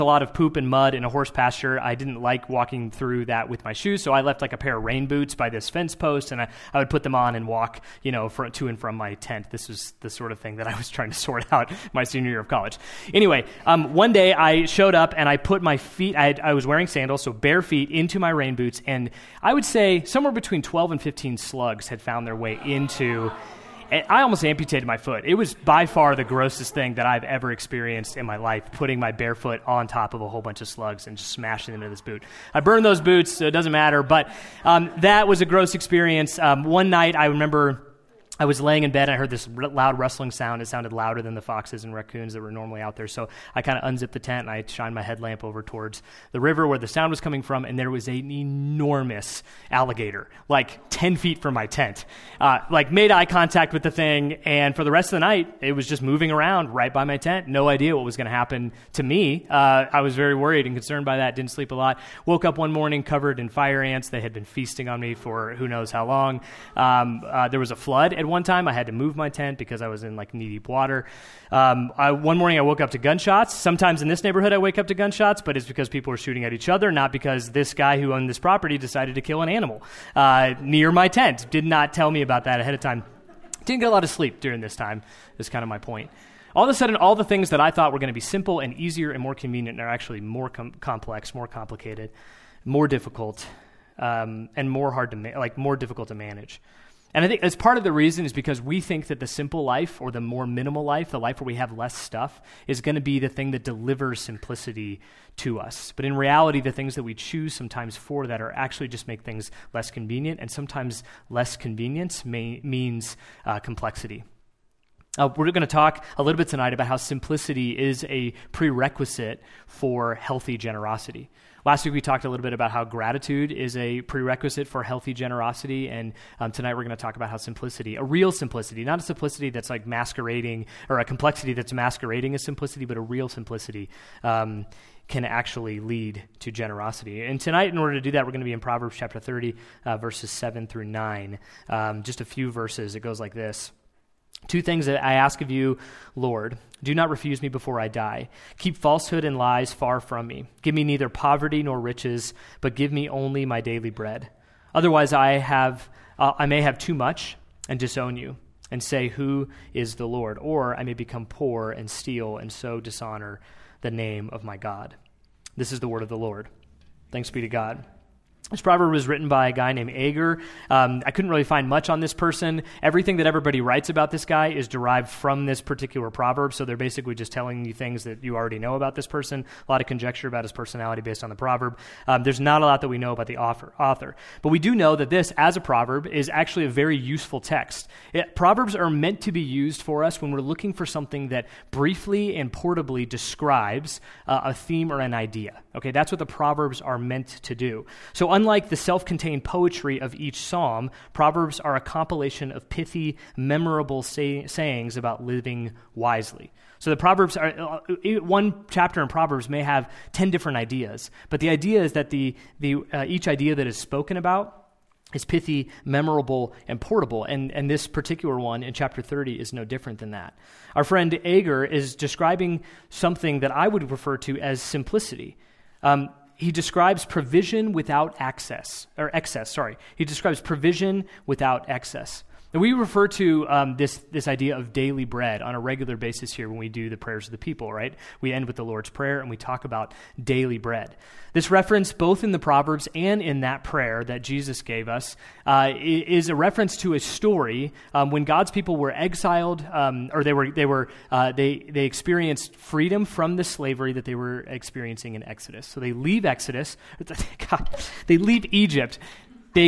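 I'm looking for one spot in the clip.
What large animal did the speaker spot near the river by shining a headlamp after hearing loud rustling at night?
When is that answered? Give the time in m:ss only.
0:49.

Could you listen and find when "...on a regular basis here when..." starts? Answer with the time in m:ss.
3:55.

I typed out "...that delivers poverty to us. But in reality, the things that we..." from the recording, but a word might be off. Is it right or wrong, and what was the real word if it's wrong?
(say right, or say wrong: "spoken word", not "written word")
wrong: "simplicity", not "poverty".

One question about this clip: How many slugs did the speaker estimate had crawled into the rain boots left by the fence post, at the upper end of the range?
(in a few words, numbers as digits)
15.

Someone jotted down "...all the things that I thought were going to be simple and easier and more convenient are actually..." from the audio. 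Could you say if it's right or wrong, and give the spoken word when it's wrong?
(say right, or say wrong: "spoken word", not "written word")
right.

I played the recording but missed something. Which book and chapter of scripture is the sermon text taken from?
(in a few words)
Proverbs 30.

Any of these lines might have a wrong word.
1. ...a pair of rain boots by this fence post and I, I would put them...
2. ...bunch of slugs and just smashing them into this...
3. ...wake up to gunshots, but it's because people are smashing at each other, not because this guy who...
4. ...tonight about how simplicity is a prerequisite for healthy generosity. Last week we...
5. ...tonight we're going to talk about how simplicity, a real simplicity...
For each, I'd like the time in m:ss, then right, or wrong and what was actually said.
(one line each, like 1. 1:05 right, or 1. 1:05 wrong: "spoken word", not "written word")
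1. 0:04 right
2. 0:30 right
3. 1:14 wrong: "shooting", not "smashing"
4. 1:56 right
5. 2:06 right.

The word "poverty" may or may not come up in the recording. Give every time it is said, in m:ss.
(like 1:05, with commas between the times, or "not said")
2:31.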